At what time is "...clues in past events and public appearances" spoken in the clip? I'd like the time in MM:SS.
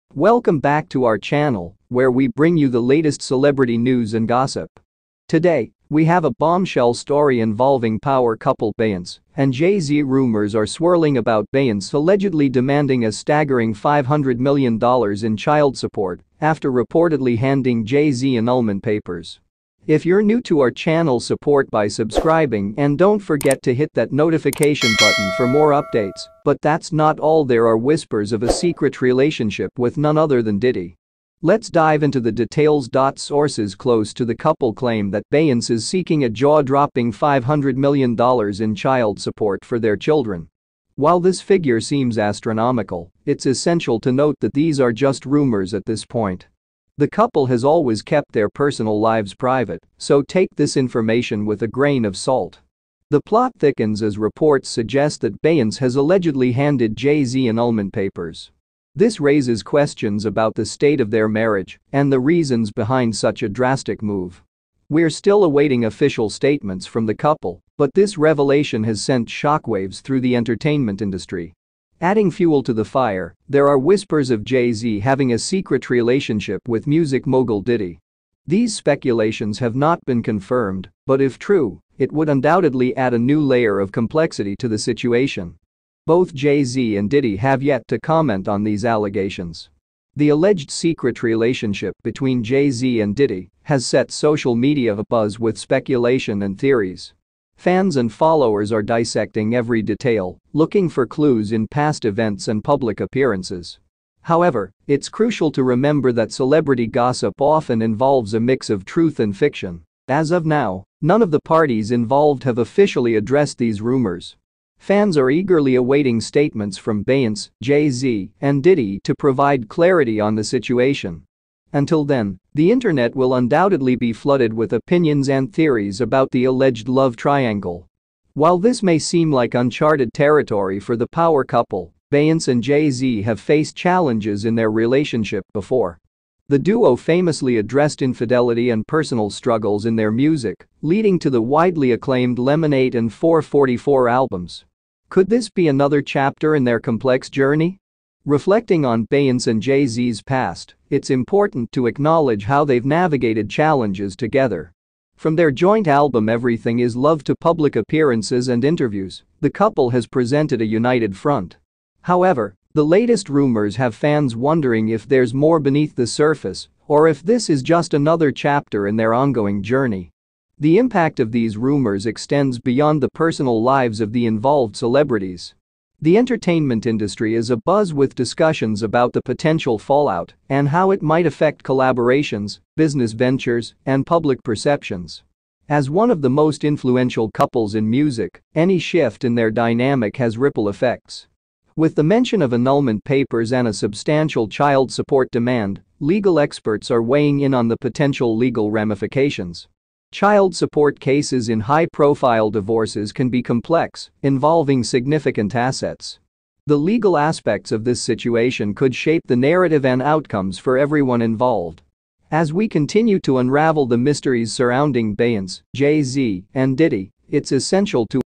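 01:41.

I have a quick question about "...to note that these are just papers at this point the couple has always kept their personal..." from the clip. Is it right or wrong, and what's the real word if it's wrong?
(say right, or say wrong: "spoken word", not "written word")
wrong: "rumors", not "papers".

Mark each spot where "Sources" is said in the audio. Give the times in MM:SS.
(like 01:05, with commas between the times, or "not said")
00:33.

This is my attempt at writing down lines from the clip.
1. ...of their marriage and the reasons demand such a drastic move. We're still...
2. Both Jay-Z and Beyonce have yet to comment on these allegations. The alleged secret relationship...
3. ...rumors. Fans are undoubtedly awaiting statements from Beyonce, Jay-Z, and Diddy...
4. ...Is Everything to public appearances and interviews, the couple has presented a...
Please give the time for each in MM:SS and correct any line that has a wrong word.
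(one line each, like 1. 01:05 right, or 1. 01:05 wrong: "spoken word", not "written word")
1. 01:00 wrong: "behind", not "demand"
2. 01:26 wrong: "Diddy", not "Beyonce"
3. 01:53 wrong: "eagerly", not "undoubtedly"
4. 02:36 wrong: "Love", not "Everything".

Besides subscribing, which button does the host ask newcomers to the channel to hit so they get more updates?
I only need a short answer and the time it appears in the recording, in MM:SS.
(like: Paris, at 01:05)
notification button, at 00:24.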